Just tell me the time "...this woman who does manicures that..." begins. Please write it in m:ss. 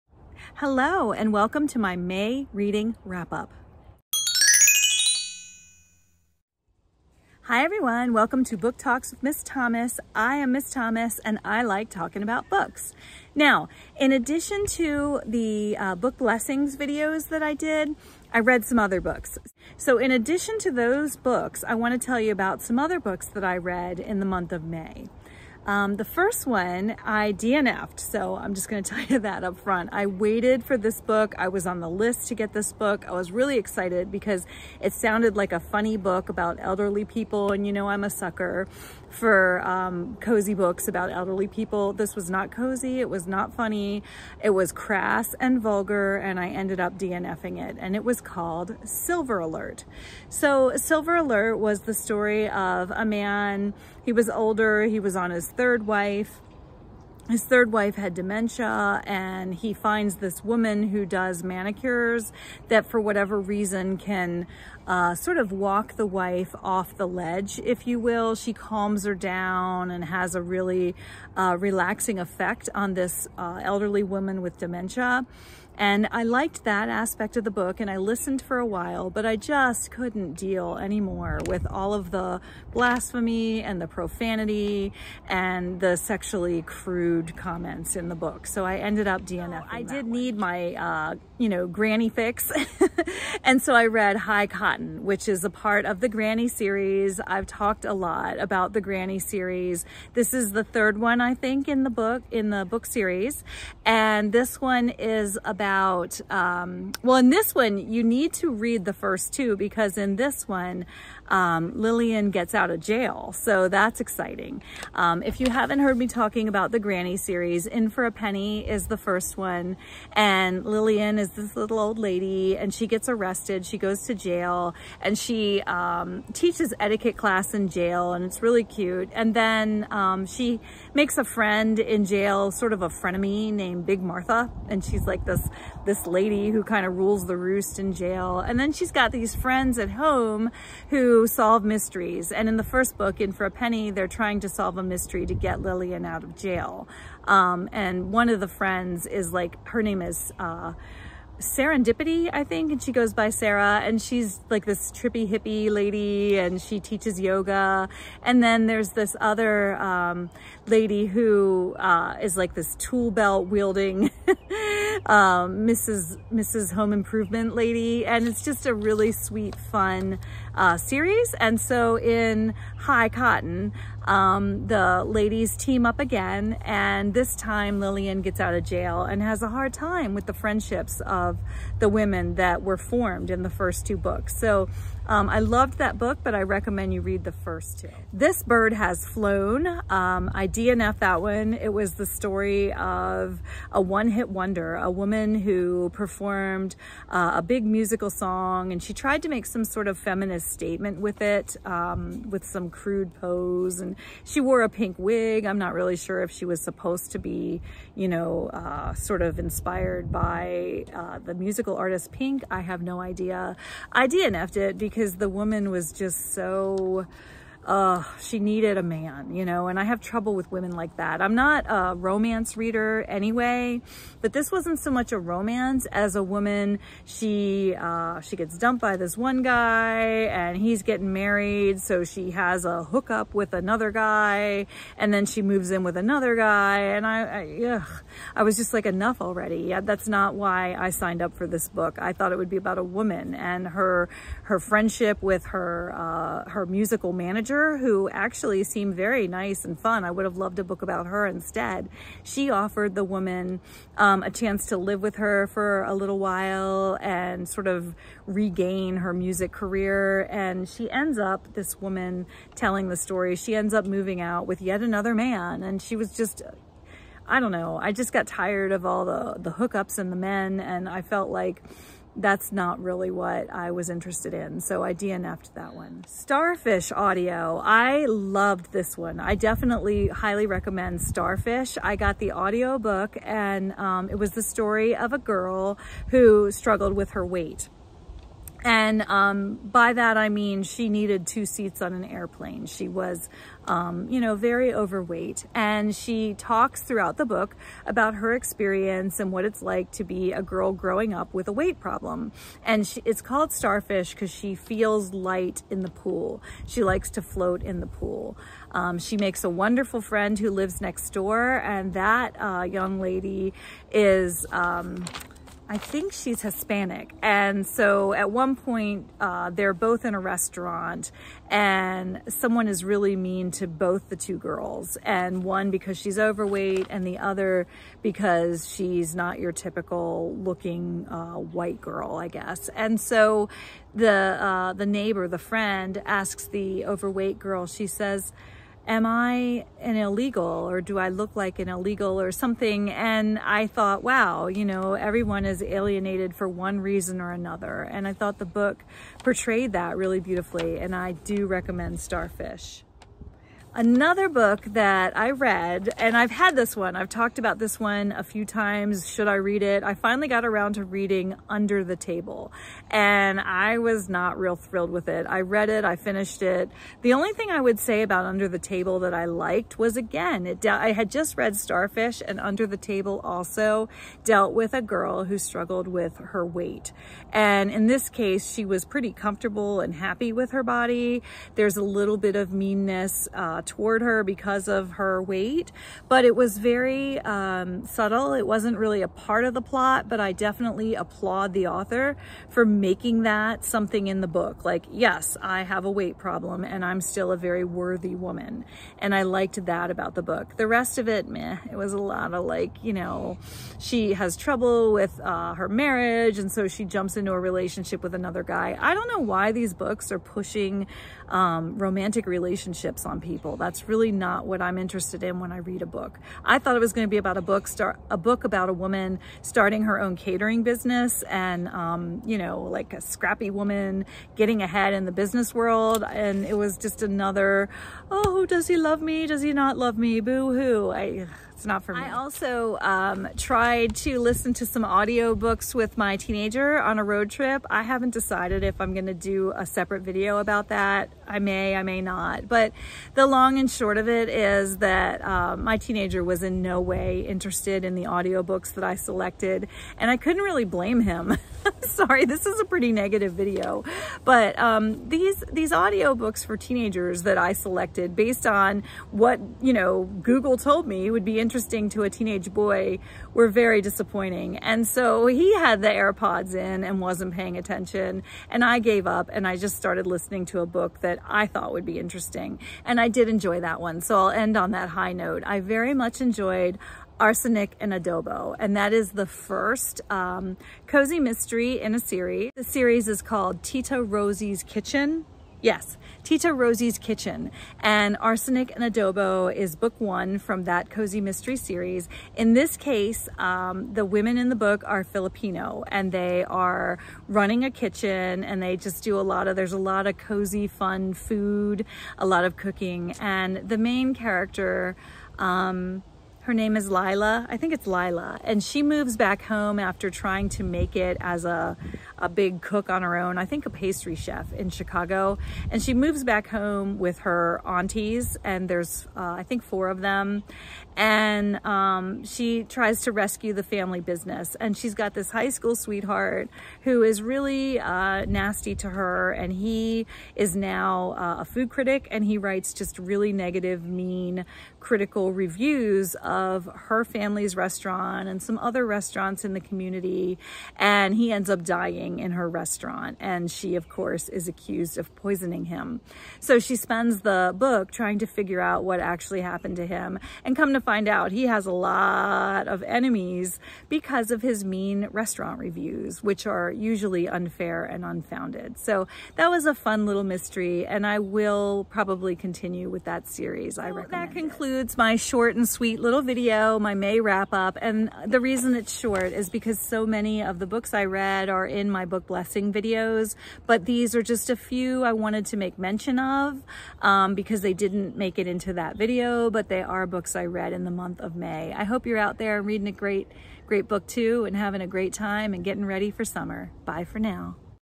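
1:00.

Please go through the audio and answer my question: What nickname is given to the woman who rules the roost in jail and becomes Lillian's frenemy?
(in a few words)
Big Martha.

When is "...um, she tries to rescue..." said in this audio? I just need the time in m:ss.
8:41.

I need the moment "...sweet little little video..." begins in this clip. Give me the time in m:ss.
9:25.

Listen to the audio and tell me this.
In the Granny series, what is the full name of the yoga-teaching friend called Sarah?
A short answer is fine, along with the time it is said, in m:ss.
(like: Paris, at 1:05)
Serendipity, at 2:31.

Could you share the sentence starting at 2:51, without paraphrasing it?
And so in High Cotton, um, the ladies team up again.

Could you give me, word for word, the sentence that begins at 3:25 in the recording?
I'm not really sure if she was supposed to be, you know, uh, sort of inspired by uh, the musical artist Pink.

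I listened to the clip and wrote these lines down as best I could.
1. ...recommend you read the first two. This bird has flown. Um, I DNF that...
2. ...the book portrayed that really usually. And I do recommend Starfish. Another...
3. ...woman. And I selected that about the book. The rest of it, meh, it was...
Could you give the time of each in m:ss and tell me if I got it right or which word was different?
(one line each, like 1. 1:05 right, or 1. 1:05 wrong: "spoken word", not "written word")
1. 3:06 right
2. 5:48 wrong: "beautifully", not "usually"
3. 6:38 wrong: "liked", not "selected".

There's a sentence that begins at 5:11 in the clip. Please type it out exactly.
And that uh, young lady is um, I think she's Hispanic.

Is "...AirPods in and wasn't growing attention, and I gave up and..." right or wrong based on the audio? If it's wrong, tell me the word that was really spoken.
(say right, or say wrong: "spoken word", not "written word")
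wrong: "paying", not "growing".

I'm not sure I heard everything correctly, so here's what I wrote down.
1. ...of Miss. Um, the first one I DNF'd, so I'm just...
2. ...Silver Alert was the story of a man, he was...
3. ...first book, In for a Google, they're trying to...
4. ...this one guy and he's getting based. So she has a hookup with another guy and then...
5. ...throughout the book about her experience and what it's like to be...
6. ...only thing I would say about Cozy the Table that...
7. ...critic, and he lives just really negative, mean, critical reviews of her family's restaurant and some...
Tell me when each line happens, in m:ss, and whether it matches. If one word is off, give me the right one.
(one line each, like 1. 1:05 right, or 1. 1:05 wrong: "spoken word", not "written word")
1. 0:24 wrong: "May", not "Miss"
2. 0:50 right
3. 2:22 wrong: "Penny", not "Google"
4. 3:48 wrong: "married", not "based"
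5. 4:56 right
6. 6:07 wrong: "Under", not "Cozy"
7. 8:51 wrong: "writes", not "lives".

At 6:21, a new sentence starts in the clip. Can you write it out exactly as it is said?
There's a little bit of meanness.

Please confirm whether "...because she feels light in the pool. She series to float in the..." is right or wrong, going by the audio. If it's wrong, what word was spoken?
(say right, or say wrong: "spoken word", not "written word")
wrong: "likes", not "series".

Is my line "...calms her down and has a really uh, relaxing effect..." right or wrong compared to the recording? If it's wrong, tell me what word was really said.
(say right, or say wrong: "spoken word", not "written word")
right.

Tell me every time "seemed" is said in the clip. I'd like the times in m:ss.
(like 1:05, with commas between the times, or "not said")
4:08.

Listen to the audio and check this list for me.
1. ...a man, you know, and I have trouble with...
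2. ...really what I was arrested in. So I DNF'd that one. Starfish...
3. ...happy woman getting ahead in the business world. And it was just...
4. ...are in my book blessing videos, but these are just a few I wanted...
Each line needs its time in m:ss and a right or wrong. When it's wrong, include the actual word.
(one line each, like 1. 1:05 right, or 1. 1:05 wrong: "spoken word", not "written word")
1. 3:38 right
2. 4:32 wrong: "interested", not "arrested"
3. 7:03 wrong: "scrappy", not "happy"
4. 9:31 right.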